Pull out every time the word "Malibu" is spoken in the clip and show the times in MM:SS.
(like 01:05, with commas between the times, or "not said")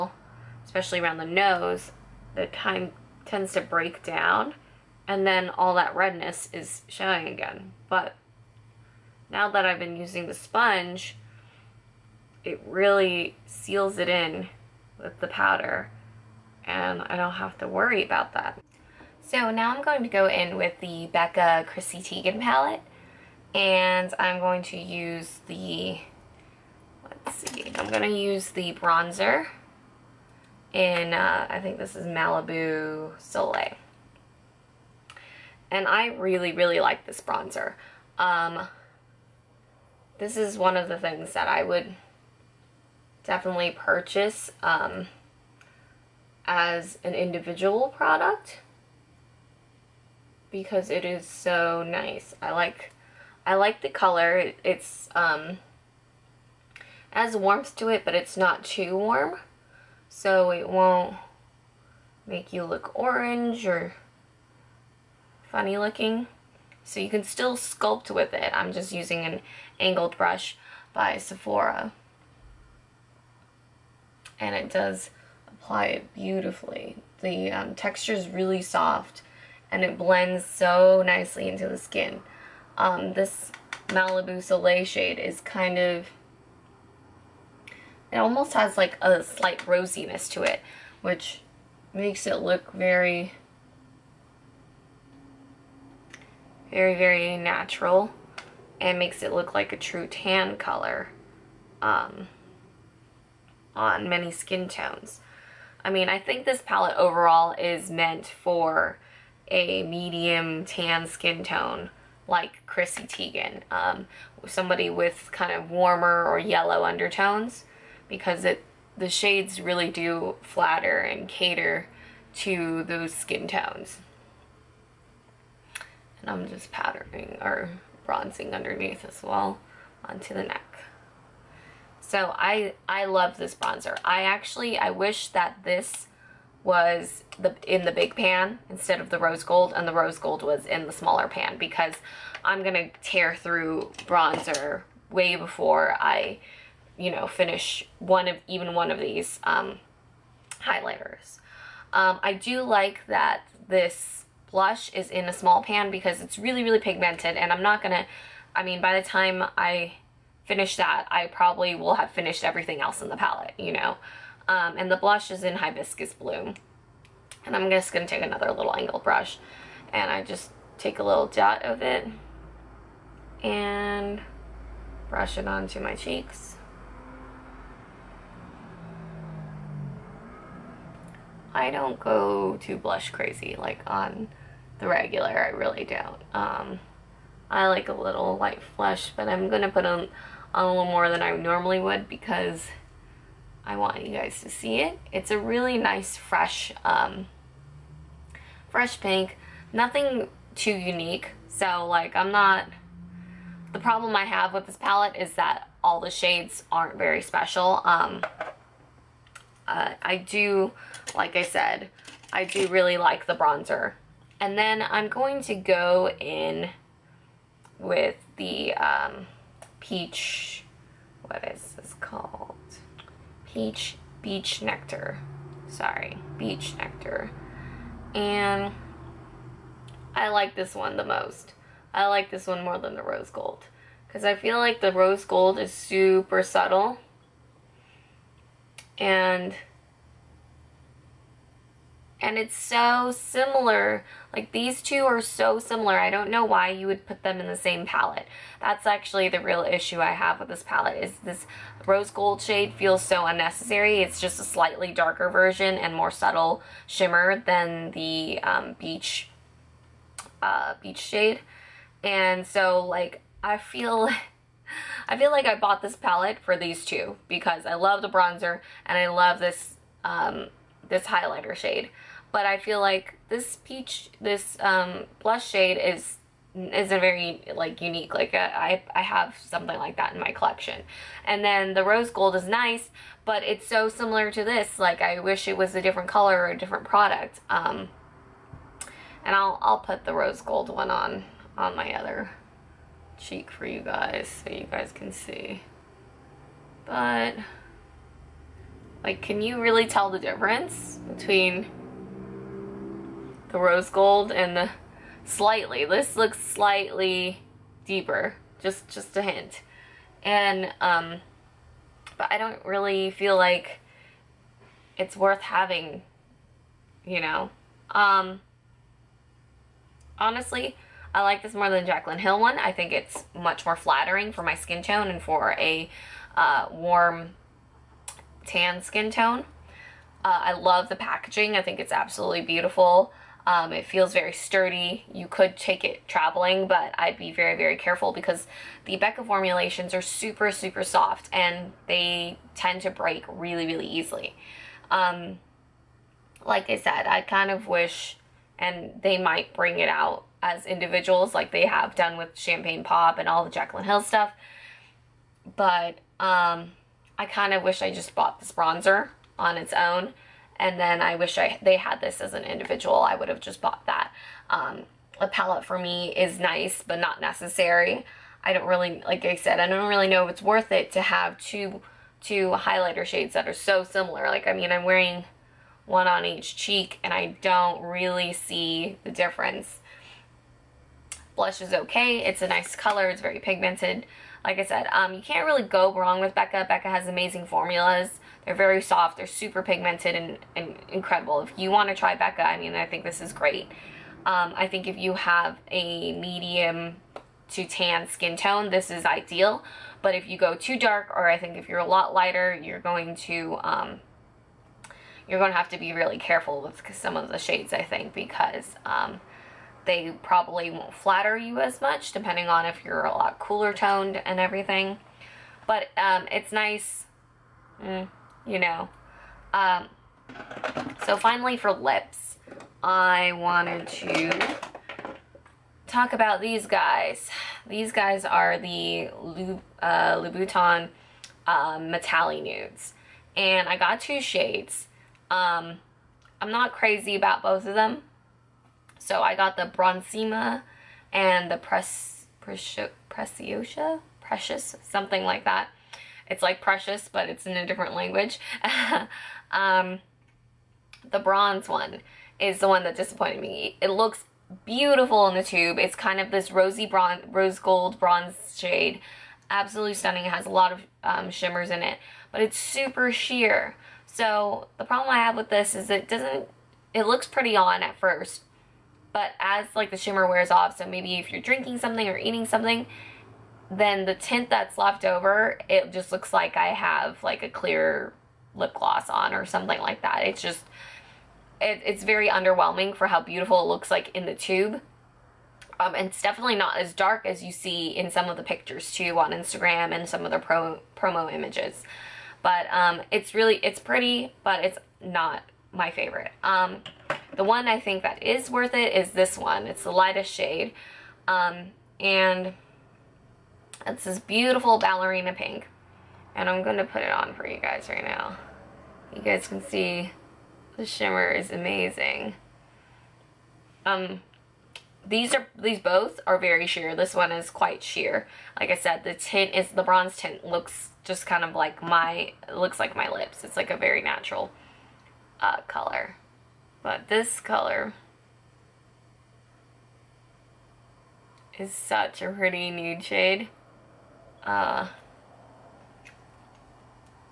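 00:32, 01:23.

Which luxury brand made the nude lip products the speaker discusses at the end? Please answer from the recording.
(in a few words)
Louboutin.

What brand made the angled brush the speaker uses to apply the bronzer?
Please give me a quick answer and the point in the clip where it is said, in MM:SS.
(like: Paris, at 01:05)
Sephora, at 01:11.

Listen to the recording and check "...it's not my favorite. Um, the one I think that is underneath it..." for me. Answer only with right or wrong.
wrong.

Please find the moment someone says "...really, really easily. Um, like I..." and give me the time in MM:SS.
05:43.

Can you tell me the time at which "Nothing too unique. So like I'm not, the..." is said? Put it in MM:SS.
03:19.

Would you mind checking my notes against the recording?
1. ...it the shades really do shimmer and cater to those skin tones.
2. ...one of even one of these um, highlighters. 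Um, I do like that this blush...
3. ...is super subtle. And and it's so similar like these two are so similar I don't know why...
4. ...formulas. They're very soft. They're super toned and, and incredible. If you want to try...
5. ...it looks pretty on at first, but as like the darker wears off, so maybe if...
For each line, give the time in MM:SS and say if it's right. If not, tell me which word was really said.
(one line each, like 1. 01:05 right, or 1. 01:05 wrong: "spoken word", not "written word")
1. 01:58 wrong: "flatter", not "shimmer"
2. 02:27 right
3. 03:55 right
4. 06:27 wrong: "pigmented", not "toned"
5. 07:46 wrong: "shimmer", not "darker".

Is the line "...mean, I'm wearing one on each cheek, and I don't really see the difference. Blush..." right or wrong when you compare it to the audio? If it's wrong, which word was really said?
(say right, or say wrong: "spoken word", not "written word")
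right.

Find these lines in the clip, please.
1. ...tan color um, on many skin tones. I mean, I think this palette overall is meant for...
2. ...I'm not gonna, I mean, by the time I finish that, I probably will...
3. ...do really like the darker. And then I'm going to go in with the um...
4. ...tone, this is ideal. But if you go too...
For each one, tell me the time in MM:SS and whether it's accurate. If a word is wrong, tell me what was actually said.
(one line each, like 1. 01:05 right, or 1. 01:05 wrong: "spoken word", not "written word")
1. 01:40 right
2. 02:37 right
3. 03:32 wrong: "bronzer", not "darker"
4. 06:38 right.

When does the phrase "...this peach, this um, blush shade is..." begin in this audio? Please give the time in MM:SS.
04:33.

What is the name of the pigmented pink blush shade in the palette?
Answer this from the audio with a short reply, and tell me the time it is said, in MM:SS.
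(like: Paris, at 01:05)
Hibiscus Bloom, at 02:45.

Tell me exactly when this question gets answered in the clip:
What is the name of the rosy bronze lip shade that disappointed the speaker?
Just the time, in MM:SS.
07:19.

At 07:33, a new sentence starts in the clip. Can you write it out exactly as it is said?
It looks beautiful in the tube.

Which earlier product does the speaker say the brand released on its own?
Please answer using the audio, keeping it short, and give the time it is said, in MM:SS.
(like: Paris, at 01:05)
Champagne Pop, at 05:52.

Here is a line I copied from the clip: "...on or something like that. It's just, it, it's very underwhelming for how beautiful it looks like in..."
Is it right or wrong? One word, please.
right.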